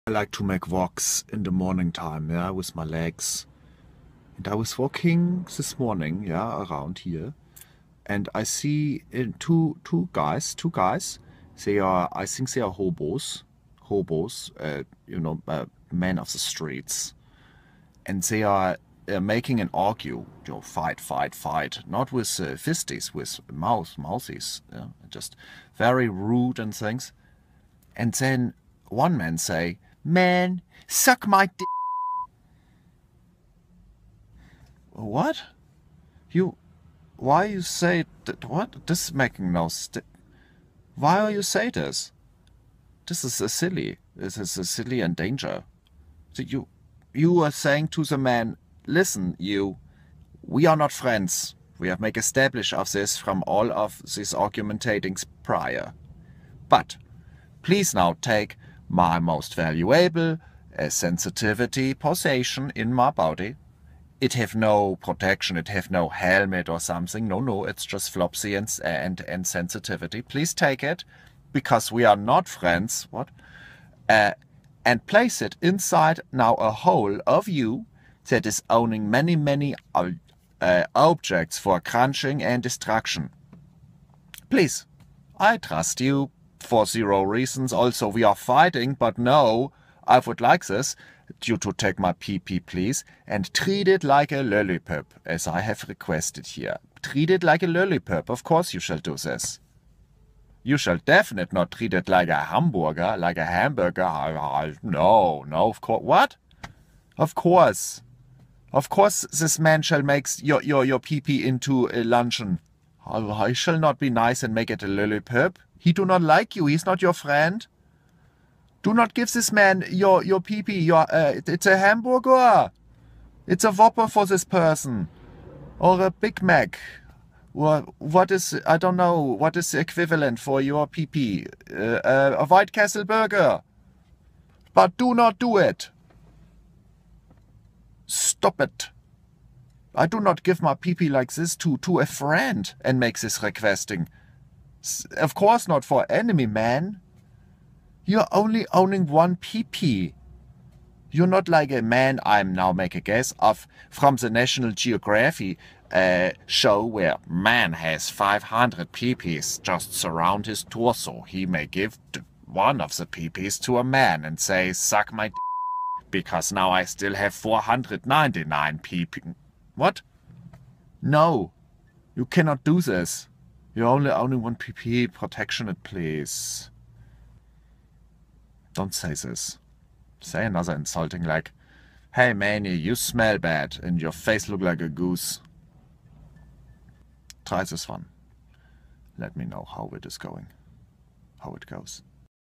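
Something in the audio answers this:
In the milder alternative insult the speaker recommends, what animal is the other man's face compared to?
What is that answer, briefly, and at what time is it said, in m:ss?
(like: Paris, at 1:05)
A goose, at 3:04.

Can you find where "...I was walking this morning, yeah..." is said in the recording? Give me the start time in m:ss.
0:04.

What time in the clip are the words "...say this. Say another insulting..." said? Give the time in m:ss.
2:58.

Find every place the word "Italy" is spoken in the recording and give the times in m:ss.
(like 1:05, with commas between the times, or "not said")
not said.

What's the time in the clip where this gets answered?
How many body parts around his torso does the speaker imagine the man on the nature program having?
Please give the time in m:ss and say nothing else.
2:38.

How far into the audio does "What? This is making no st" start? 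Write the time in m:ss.
0:38.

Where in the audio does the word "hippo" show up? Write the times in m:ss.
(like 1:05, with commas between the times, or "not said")
not said.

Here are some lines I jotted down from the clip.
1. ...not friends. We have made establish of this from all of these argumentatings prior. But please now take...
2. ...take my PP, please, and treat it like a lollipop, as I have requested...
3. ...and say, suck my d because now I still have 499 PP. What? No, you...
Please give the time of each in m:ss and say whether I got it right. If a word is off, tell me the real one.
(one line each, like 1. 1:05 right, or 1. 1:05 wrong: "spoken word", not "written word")
1. 0:50 right
2. 1:31 right
3. 2:44 right.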